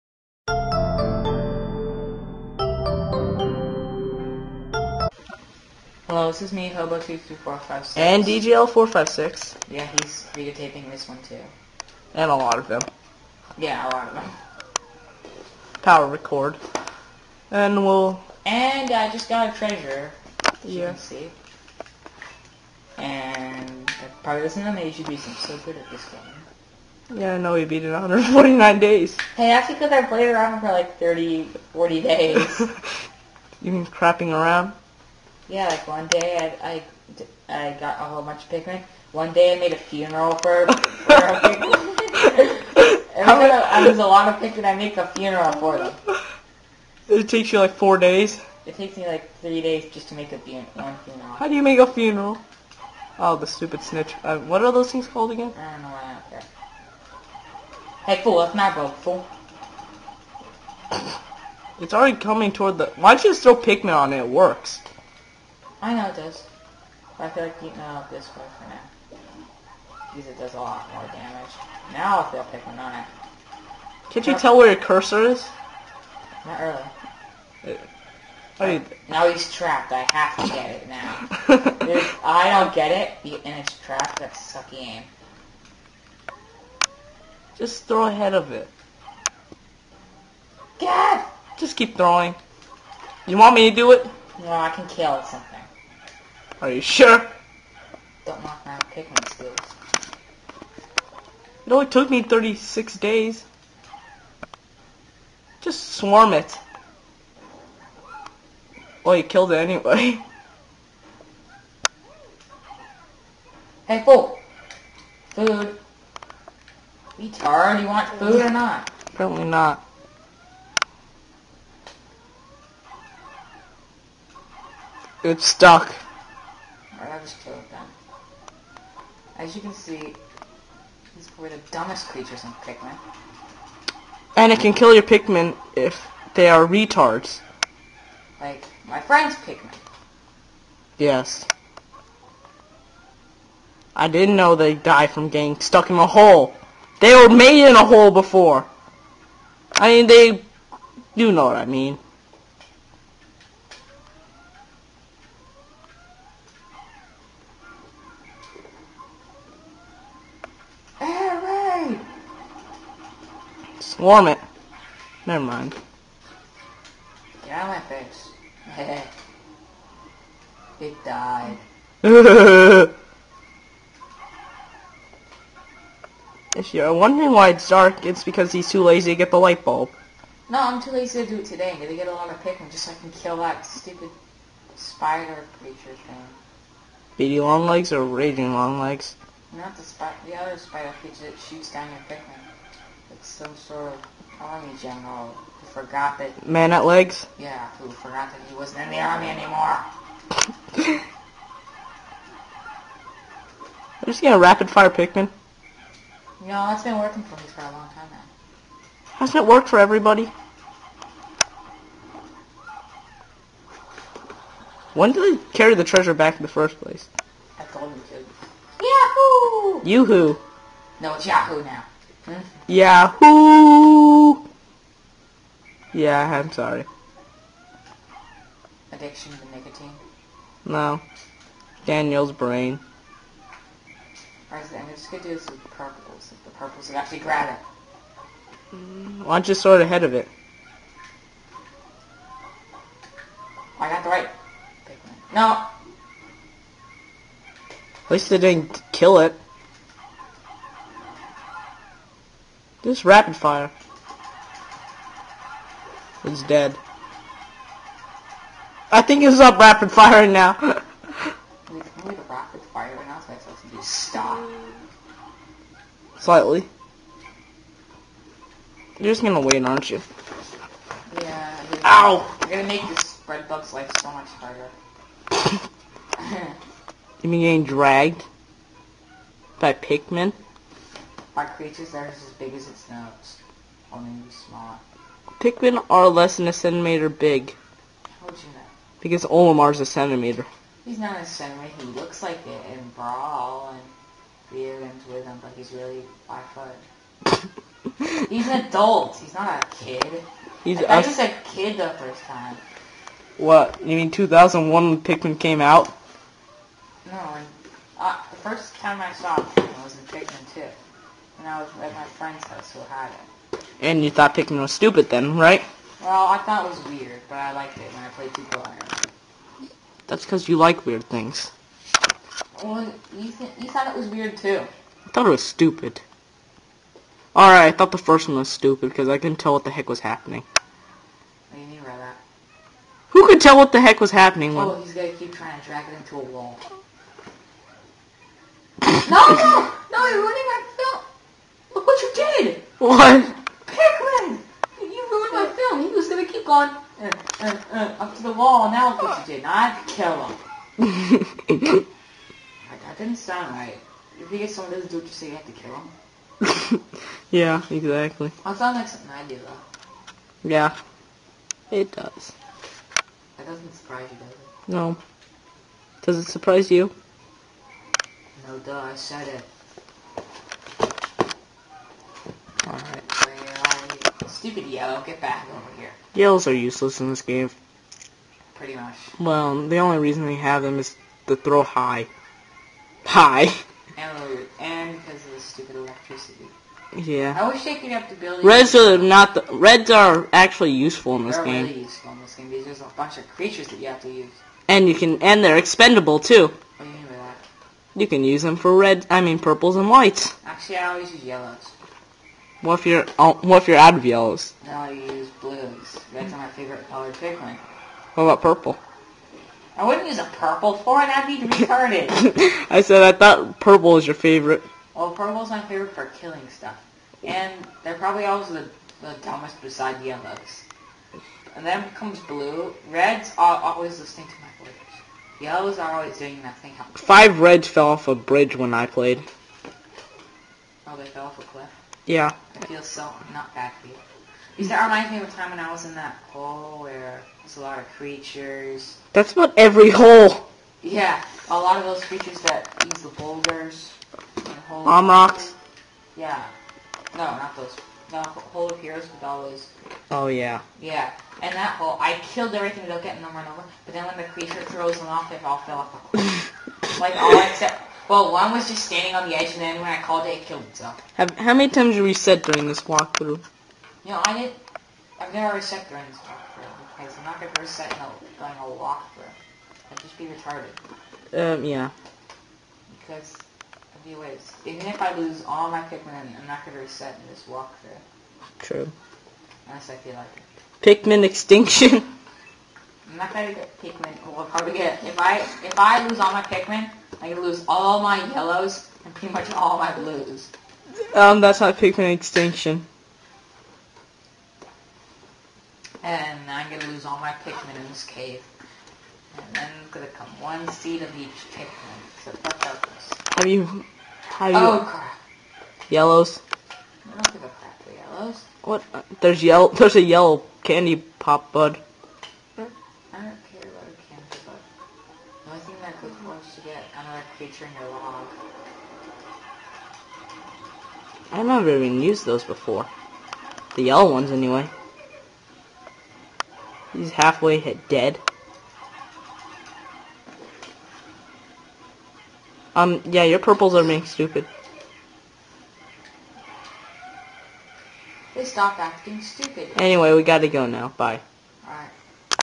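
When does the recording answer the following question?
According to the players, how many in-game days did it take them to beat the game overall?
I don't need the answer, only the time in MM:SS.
00:27.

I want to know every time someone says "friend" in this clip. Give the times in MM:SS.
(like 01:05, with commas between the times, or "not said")
02:19, 05:12.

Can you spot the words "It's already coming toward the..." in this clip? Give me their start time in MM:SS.
01:01.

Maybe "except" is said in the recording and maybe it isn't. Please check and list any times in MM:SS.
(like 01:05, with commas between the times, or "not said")
07:37.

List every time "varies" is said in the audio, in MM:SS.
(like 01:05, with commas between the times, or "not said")
not said.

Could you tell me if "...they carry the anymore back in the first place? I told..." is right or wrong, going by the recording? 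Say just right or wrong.
wrong.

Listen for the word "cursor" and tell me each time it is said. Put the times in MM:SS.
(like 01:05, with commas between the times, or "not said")
01:14.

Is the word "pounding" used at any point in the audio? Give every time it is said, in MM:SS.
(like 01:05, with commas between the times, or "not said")
not said.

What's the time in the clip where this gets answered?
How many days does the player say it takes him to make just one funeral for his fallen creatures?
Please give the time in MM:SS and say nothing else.
00:49.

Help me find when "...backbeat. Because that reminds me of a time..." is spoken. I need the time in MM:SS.
07:13.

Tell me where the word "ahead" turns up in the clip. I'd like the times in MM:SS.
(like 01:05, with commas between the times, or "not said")
01:28, 03:59.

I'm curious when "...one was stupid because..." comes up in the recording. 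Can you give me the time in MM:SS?
05:28.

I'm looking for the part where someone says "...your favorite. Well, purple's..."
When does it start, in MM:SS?
06:54.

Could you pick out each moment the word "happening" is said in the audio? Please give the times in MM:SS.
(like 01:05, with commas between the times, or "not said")
05:30, 05:34.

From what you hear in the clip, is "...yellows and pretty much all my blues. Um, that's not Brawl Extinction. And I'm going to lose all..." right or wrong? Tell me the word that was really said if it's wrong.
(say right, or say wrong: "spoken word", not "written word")
wrong: "Pikmin", not "Brawl".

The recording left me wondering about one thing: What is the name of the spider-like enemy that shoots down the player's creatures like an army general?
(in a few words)
Man-at-Legs.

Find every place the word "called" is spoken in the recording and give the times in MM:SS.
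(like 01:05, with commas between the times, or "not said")
00:55, 07:40.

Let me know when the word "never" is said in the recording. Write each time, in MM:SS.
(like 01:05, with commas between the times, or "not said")
02:45, 07:45, 08:41.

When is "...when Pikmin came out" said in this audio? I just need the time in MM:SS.
05:04.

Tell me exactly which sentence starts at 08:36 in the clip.
get another creature in your log.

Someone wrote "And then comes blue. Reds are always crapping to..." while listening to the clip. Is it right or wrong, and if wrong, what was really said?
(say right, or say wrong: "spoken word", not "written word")
wrong: "listening", not "crapping".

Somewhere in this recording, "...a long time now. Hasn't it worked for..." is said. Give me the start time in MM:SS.
03:27.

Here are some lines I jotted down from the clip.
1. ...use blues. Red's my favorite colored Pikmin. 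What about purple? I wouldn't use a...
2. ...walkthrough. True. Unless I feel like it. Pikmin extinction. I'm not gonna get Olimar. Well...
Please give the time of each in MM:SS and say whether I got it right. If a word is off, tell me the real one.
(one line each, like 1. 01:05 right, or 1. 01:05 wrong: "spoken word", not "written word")
1. 06:44 right
2. 07:57 wrong: "Pikmin", not "Olimar".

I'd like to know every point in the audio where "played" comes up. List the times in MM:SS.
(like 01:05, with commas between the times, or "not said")
00:30, 05:18, 07:08.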